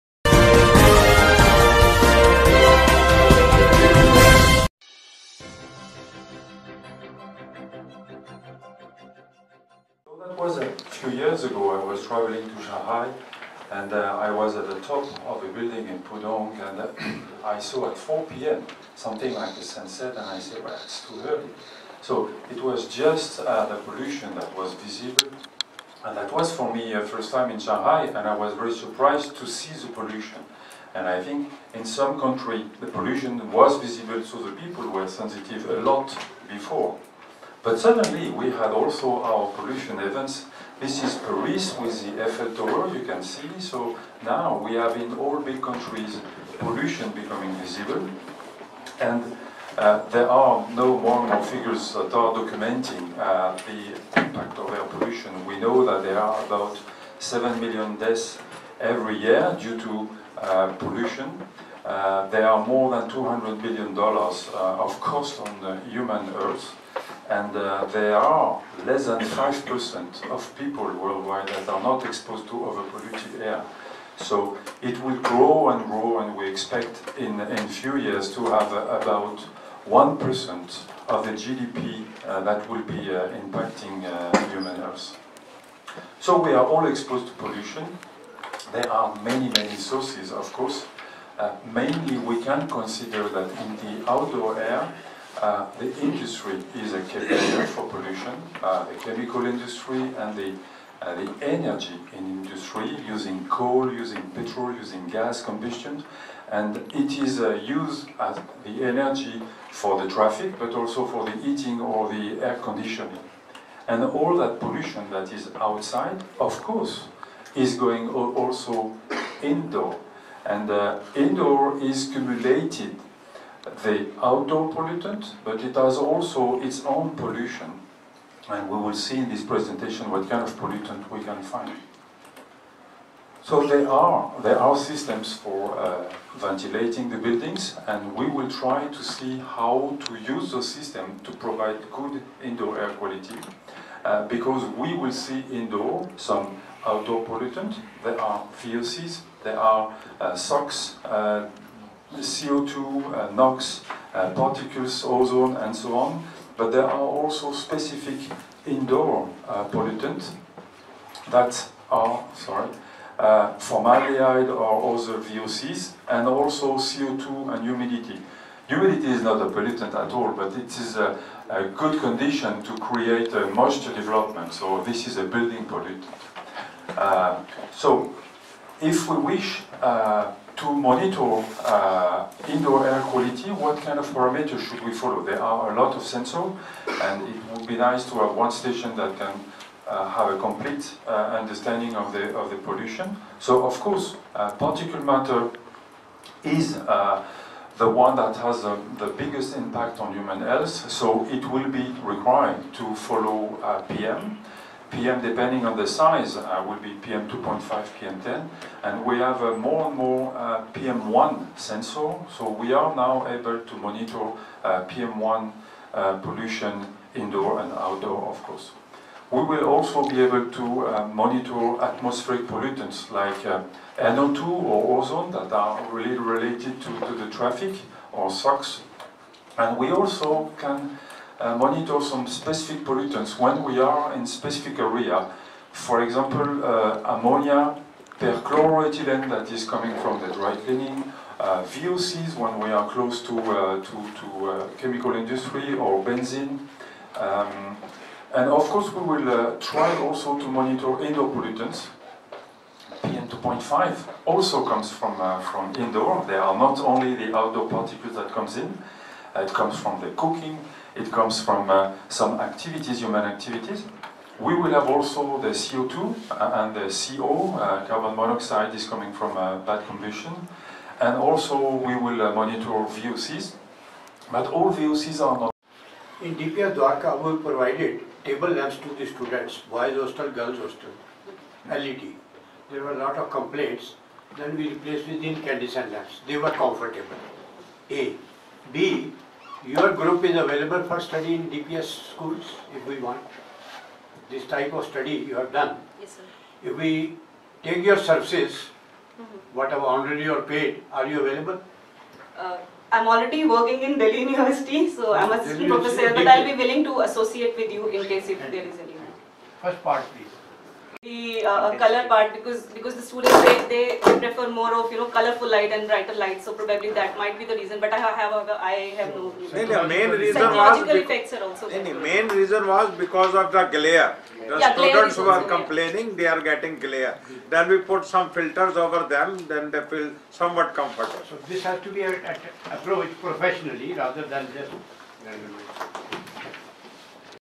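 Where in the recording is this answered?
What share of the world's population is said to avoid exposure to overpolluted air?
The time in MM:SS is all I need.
01:08.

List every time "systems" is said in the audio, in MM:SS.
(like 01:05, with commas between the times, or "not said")
02:14, 02:20.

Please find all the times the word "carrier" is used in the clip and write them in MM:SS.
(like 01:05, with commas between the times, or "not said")
01:37.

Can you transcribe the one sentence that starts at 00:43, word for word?
So now we have in all big countries pollution becoming visible.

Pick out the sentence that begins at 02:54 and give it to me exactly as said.
So this is a building pollutant.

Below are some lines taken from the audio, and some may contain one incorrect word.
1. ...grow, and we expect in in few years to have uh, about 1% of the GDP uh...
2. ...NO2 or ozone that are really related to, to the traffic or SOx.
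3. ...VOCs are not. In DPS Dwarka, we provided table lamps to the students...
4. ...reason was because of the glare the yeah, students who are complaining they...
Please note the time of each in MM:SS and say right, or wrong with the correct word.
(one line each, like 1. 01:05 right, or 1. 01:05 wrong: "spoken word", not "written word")
1. 01:15 right
2. 03:43 right
3. 04:34 right
4. 05:22 right.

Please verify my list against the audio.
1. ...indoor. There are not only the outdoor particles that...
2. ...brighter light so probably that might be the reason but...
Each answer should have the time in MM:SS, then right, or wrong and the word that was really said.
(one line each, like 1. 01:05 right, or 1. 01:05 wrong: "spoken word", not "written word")
1. 04:15 right
2. 05:15 right.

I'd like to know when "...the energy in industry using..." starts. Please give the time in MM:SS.
01:41.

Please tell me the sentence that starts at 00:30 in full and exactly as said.
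And I think in some country the pollution was visible, so the people were sensitive a lot before.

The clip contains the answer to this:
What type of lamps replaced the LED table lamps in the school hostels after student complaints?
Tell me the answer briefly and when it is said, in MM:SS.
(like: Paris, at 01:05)
incandescent lamps, at 04:45.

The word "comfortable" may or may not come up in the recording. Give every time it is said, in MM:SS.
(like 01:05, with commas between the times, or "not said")
04:46, 05:30.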